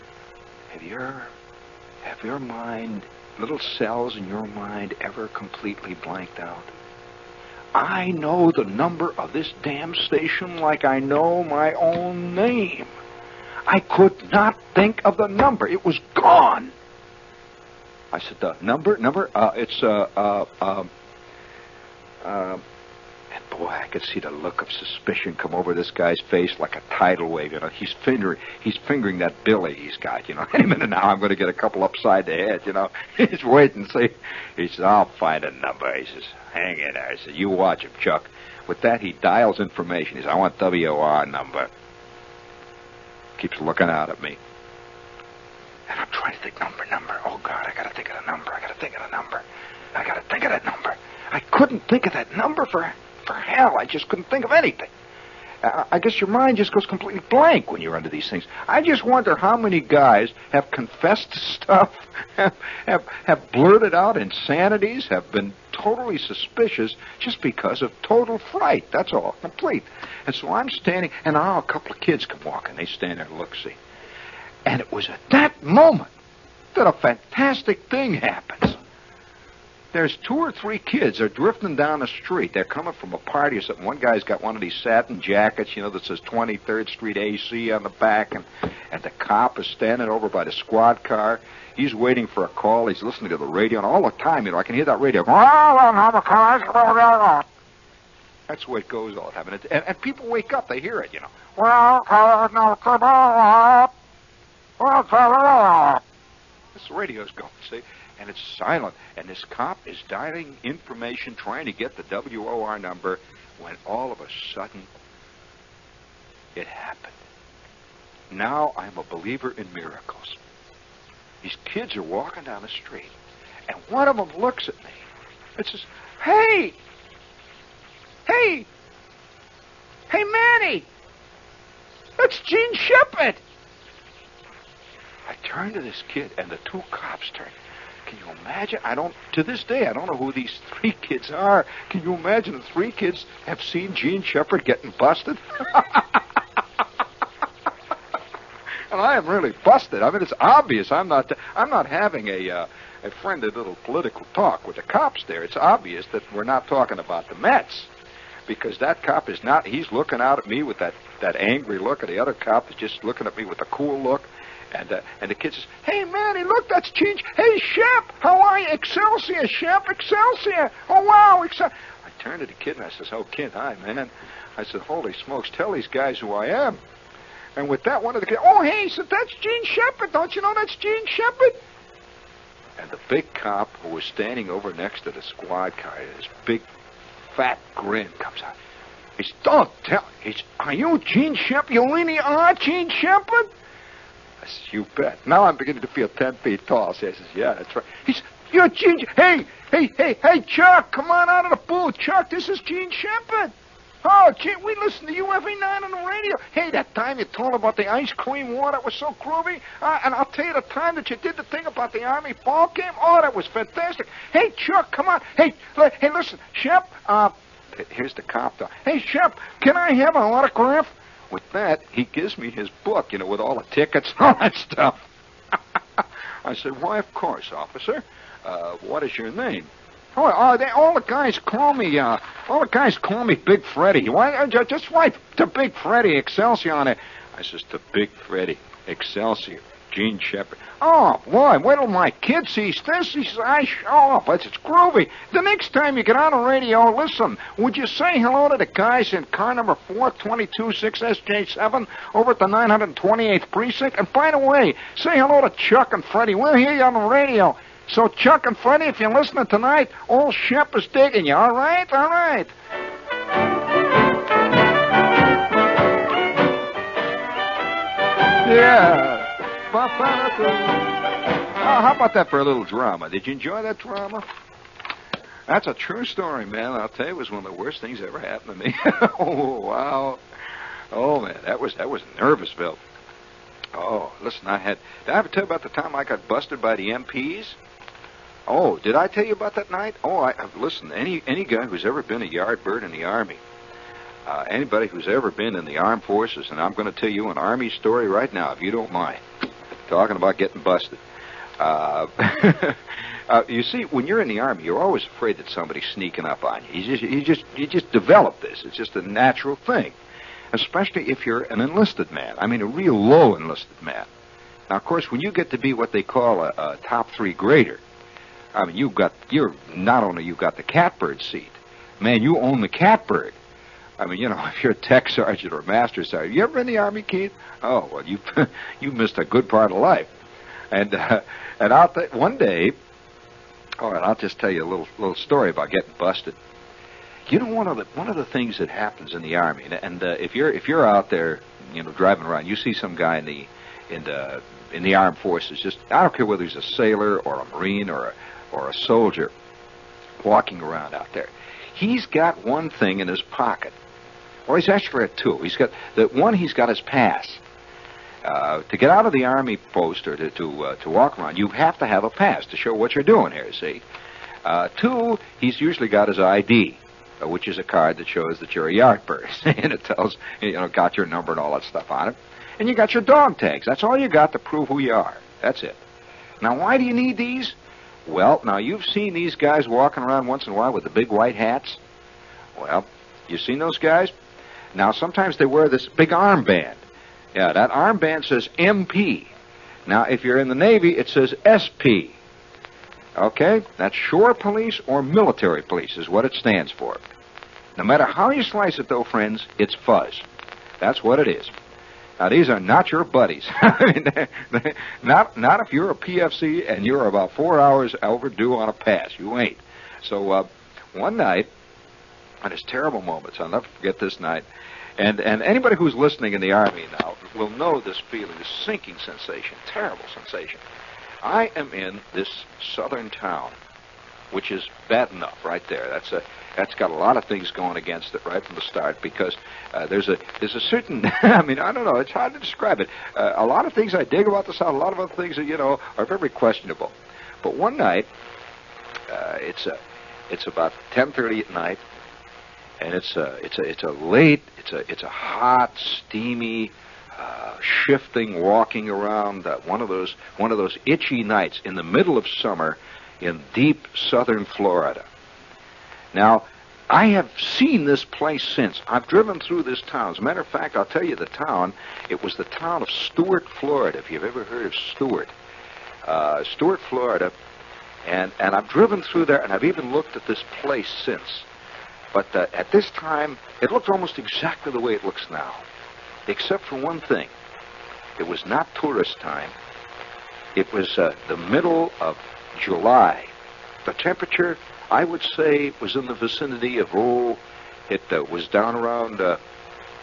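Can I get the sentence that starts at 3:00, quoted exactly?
Don't you know that's Jean Shepherd?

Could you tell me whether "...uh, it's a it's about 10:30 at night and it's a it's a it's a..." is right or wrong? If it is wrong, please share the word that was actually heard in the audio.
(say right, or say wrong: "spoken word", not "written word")
right.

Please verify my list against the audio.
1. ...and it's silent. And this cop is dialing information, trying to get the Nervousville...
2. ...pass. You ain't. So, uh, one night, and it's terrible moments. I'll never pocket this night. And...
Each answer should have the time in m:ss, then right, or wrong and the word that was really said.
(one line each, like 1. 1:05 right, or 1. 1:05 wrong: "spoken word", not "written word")
1. 1:48 wrong: "WOR", not "Nervousville"
2. 6:48 wrong: "forget", not "pocket".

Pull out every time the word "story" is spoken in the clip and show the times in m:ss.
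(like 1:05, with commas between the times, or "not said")
4:36, 4:57, 5:35.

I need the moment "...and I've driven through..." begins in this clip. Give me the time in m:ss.
7:48.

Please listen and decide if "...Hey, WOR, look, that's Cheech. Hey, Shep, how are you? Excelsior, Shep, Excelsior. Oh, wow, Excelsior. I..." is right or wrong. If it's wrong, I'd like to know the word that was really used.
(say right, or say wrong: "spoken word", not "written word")
wrong: "Manny", not "WOR".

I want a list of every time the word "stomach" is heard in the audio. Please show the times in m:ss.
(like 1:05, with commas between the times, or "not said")
not said.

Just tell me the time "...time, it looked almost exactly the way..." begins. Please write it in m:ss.
7:52.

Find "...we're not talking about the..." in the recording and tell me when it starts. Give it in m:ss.
2:36.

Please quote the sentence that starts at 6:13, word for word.
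That's all you got to prove who you are.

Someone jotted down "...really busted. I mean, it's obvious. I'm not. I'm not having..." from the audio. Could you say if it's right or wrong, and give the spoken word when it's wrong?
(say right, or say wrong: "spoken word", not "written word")
right.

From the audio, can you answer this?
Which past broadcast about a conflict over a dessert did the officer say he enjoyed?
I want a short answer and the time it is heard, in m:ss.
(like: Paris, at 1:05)
the ice cream war, at 3:27.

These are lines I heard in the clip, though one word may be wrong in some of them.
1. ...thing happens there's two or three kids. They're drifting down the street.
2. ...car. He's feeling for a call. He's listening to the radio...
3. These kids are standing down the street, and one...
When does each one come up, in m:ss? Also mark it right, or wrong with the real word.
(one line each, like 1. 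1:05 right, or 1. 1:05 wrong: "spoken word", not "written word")
1. 1:17 right
2. 1:31 wrong: "waiting", not "feeling"
3. 2:01 wrong: "walking", not "standing".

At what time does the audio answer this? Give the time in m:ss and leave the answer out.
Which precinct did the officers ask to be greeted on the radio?
4:12.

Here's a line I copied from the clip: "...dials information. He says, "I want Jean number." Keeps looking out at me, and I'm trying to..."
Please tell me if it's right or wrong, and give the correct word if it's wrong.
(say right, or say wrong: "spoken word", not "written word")
wrong: "WOR", not "Jean".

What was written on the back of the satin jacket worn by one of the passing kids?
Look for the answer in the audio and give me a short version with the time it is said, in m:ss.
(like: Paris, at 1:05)
23rd Street AC, at 1:26.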